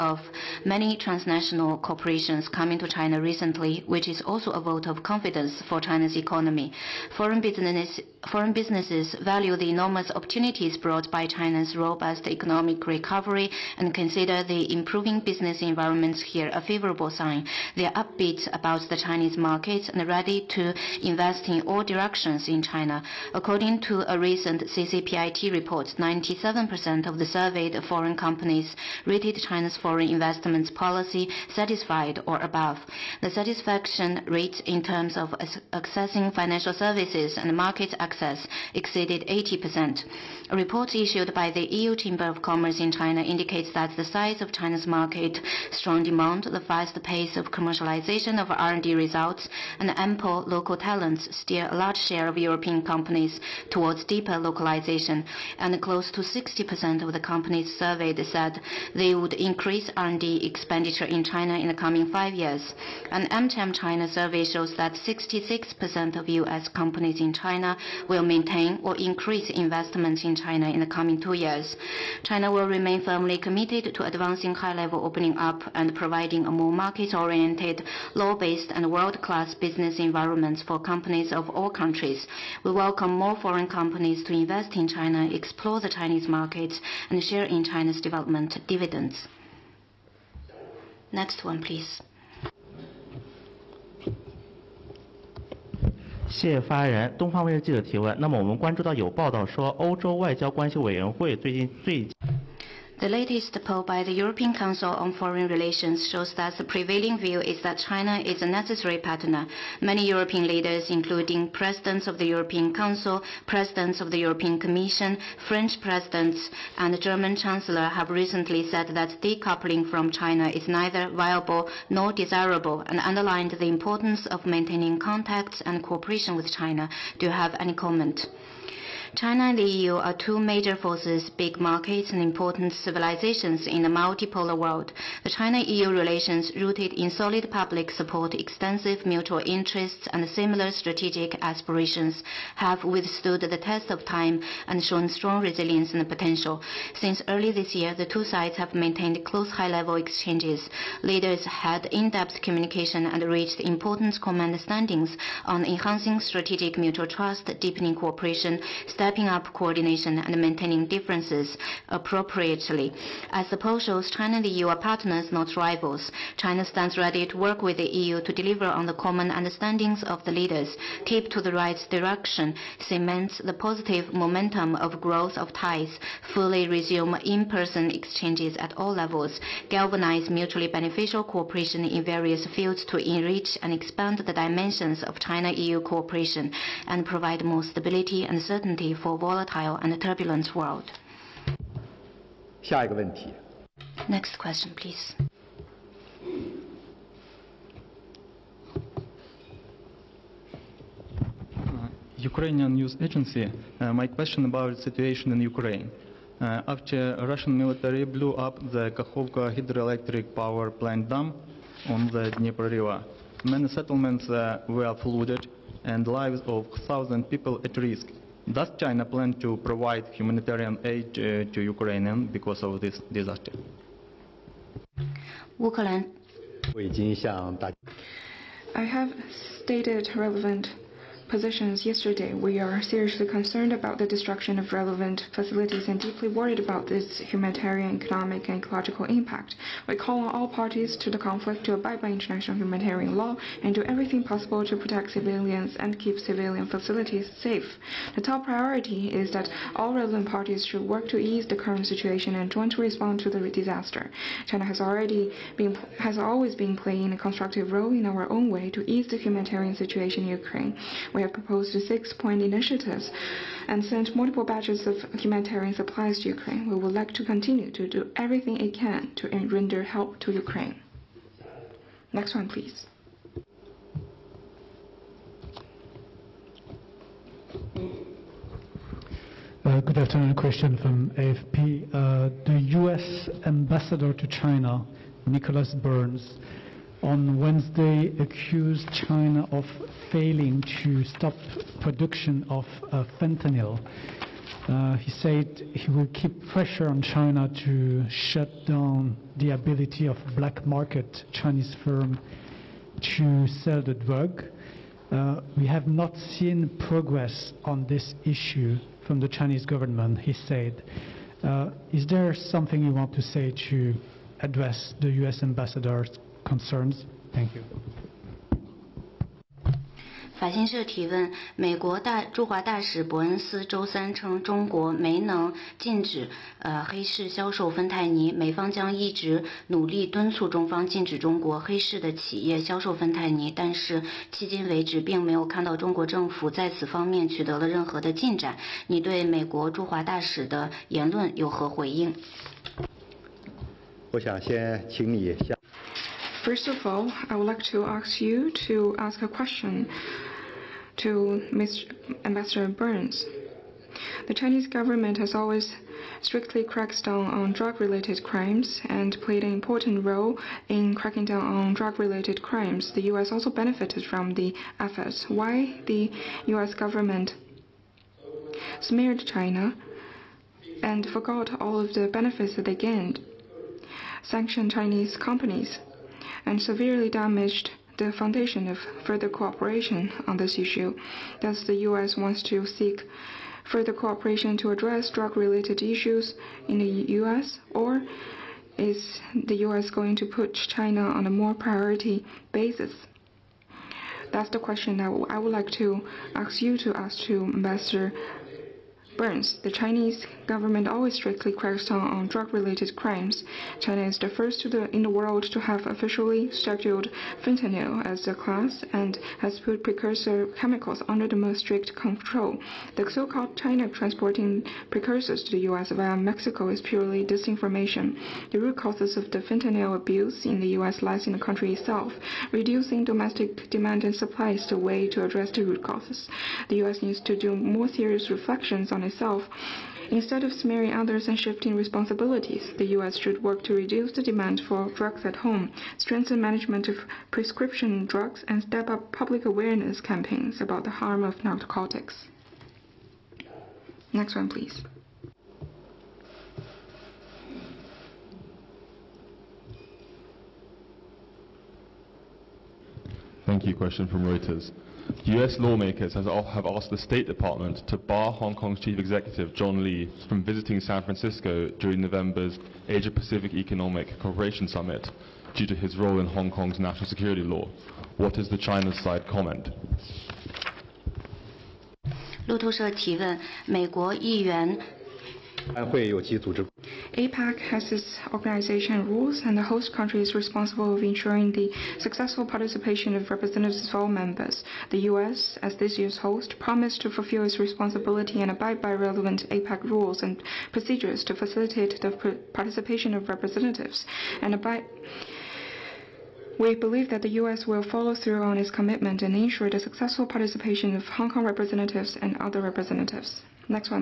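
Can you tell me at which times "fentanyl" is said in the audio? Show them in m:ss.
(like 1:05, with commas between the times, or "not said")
4:53, 6:47, 6:59.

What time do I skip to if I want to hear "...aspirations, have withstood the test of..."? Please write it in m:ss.
2:21.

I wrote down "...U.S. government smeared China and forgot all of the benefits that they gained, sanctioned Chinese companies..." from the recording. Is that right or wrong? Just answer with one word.
right.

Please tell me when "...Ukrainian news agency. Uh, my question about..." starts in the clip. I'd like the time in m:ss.
3:22.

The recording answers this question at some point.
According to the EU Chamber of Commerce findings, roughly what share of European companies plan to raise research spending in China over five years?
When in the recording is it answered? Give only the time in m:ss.
0:55.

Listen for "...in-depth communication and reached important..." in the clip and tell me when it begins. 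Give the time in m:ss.
2:31.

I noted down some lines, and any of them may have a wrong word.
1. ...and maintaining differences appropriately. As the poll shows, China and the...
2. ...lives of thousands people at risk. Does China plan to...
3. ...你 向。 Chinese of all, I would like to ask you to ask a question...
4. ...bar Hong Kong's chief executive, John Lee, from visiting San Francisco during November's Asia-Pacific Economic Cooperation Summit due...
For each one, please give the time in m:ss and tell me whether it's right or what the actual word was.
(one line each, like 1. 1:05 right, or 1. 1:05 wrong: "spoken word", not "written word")
1. 2:40 right
2. 3:36 right
3. 5:45 wrong: "First", not "Chinese"
4. 7:37 right.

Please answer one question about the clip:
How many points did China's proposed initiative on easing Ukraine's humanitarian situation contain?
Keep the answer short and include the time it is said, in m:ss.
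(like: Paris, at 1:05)
6, at 4:21.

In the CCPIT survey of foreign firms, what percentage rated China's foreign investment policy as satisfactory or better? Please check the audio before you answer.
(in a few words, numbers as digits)
97%.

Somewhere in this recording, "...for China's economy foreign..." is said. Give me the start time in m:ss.
0:05.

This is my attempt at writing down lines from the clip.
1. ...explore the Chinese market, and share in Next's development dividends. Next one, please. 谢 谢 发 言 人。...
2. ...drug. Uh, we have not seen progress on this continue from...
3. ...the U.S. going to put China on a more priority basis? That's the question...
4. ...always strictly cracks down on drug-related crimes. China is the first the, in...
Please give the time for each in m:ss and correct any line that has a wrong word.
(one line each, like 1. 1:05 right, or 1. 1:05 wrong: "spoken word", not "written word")
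1. 1:25 wrong: "China", not "Next"
2. 5:03 wrong: "issue", not "continue"
3. 6:29 right
4. 6:40 right.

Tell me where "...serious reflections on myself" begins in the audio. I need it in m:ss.
7:07.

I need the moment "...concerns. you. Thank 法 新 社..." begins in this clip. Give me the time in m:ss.
5:16.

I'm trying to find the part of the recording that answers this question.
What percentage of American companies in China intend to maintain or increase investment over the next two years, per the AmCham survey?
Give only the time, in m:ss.
1:04.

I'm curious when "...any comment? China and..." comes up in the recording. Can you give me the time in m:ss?
2:07.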